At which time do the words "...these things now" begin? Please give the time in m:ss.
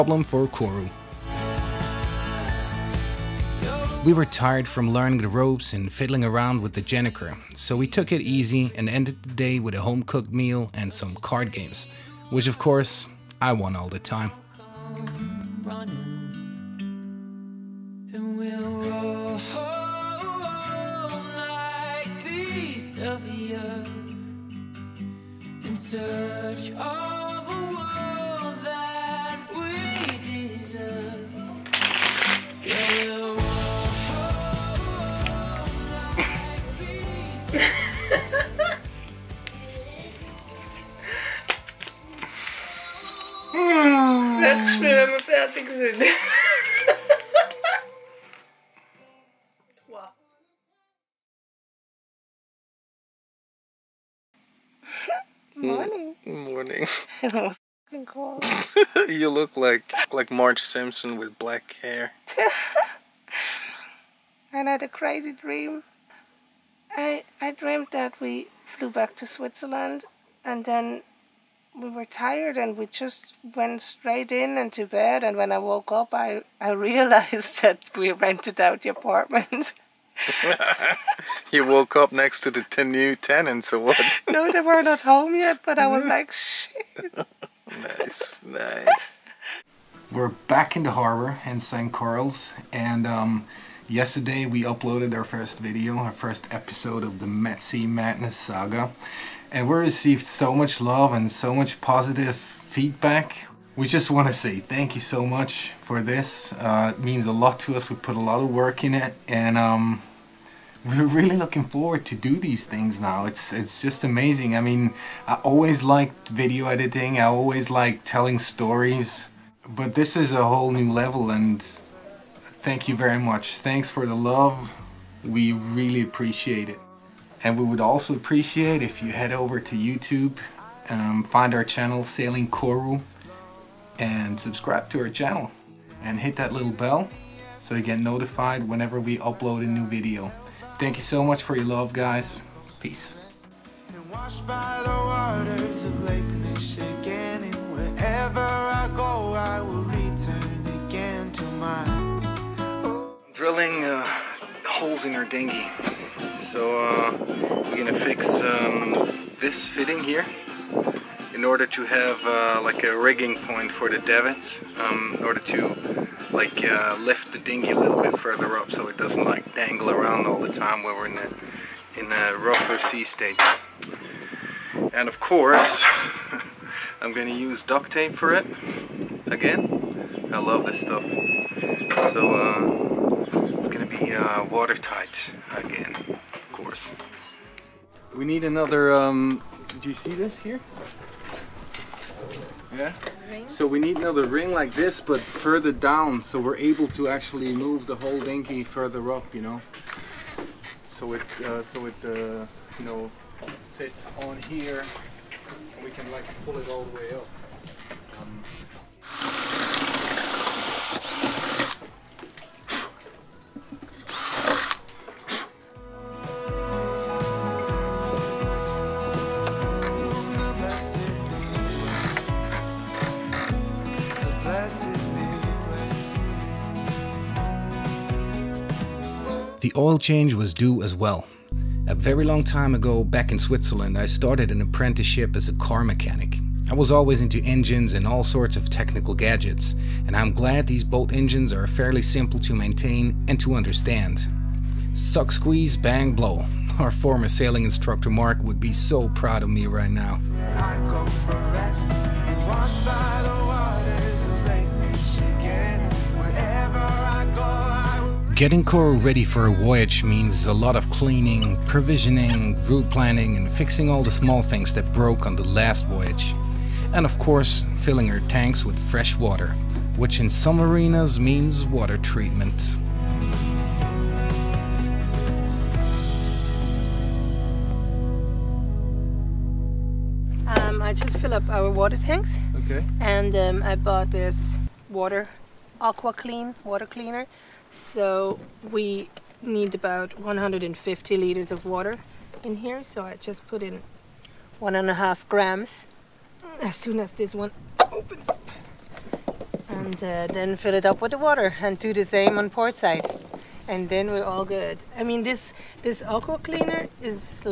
1:52.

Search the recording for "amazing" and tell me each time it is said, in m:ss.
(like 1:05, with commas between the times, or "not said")
1:54.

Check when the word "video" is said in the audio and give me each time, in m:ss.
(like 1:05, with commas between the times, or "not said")
1:35, 1:56, 2:19.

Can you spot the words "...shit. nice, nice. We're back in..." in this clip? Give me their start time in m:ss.
1:26.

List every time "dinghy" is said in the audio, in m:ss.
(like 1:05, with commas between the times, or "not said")
2:35, 2:47, 3:18.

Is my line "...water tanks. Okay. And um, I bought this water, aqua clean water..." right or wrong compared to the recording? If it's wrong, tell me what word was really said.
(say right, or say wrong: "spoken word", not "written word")
right.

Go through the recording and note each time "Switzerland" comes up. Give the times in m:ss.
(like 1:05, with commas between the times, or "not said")
1:09, 3:53.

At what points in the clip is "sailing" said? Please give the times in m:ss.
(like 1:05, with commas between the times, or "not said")
2:12, 4:07.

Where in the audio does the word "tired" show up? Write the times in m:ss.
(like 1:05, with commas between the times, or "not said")
0:04, 1:12.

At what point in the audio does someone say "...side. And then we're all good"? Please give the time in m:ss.
5:02.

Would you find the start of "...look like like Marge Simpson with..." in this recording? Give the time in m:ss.
0:59.